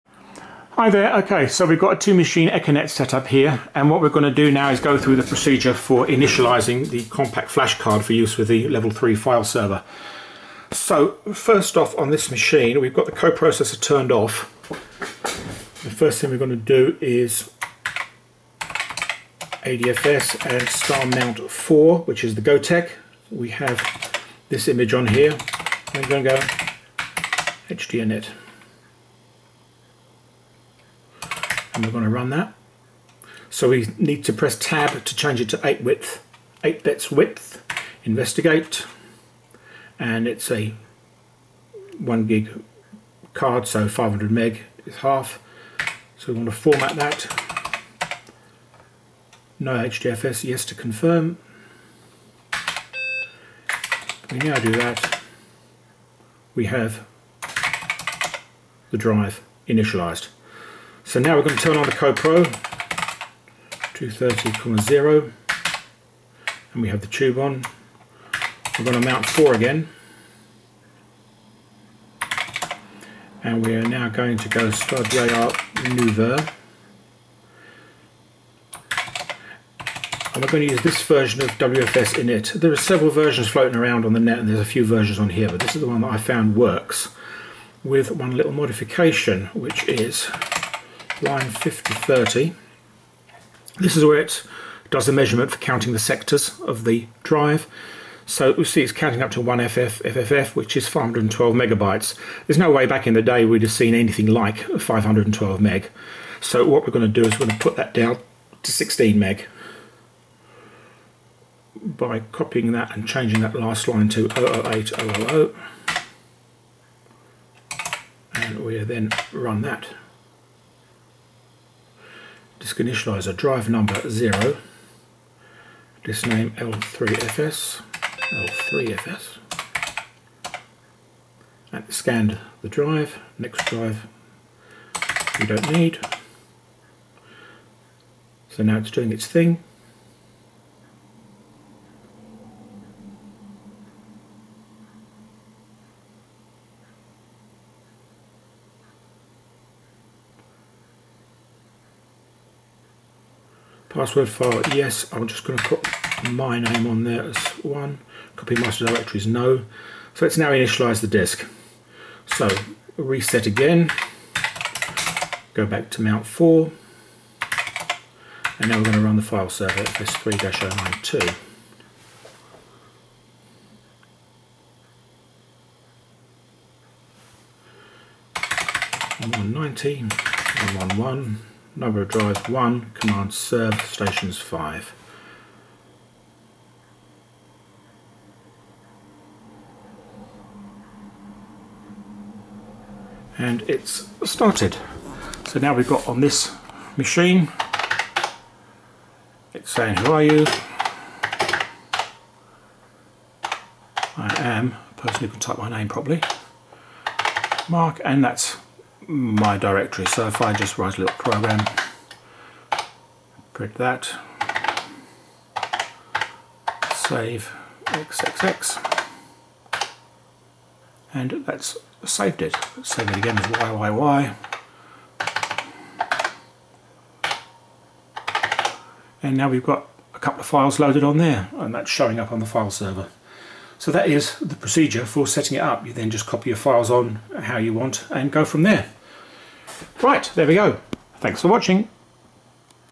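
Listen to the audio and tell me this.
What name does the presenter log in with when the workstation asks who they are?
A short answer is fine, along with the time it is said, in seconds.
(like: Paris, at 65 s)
Mark, at 207 s.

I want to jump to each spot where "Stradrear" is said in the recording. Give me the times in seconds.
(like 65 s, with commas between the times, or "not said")
74 s.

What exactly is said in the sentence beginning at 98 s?
So we see it's counting up to 1FF FFF, which is 512 megabytes.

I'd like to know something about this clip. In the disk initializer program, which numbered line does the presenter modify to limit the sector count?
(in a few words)
5030.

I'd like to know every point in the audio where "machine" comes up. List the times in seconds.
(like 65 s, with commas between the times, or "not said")
2 s, 12 s, 196 s.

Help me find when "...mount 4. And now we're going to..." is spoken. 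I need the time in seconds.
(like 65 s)
166 s.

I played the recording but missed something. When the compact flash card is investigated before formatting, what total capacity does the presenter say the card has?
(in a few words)
1 gig.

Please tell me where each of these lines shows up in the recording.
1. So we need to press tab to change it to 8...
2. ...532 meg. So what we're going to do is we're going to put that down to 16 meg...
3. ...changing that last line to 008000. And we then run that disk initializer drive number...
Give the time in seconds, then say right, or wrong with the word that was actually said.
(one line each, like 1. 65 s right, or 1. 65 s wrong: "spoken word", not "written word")
1. 33 s right
2. 104 s wrong: "512", not "532"
3. 113 s right.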